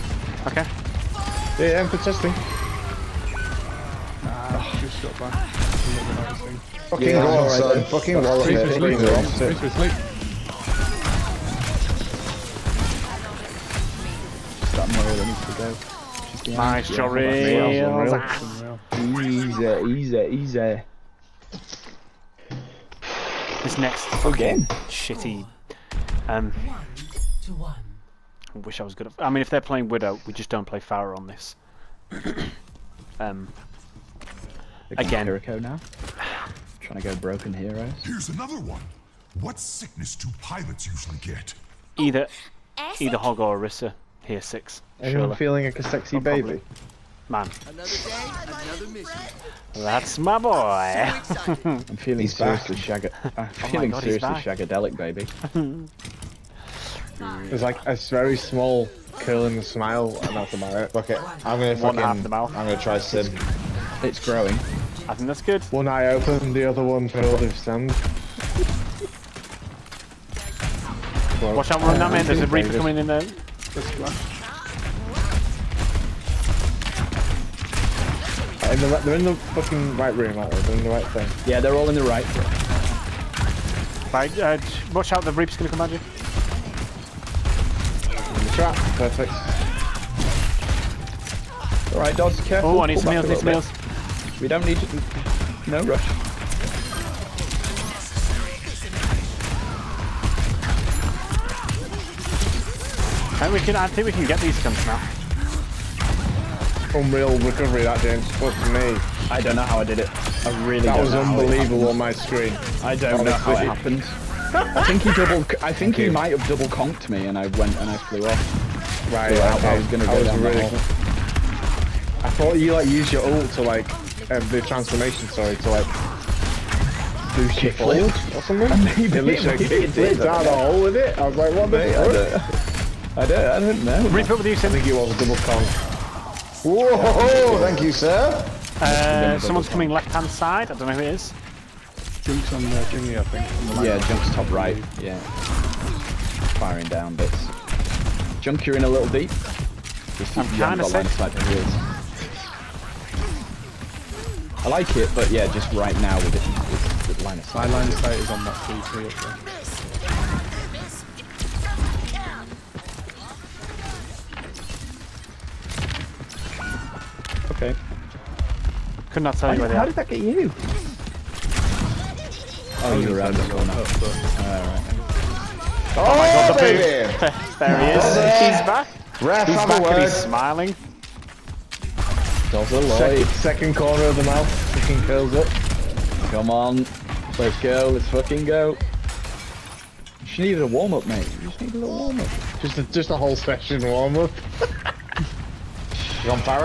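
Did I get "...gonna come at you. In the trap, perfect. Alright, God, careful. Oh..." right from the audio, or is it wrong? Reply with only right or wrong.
wrong.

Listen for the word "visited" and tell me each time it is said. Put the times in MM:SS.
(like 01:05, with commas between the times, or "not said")
not said.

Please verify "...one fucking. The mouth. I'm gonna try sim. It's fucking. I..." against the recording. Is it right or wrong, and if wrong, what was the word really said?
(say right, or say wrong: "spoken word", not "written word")
wrong: "growing", not "fucking".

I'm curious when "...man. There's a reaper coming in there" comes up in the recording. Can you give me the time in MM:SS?
01:12.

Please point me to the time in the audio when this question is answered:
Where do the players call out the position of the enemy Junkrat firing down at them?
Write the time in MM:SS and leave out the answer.
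02:24.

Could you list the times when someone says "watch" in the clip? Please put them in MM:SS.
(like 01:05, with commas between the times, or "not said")
01:11, 01:24.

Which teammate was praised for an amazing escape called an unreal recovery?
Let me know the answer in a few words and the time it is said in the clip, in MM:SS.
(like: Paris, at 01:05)
James, at 01:47.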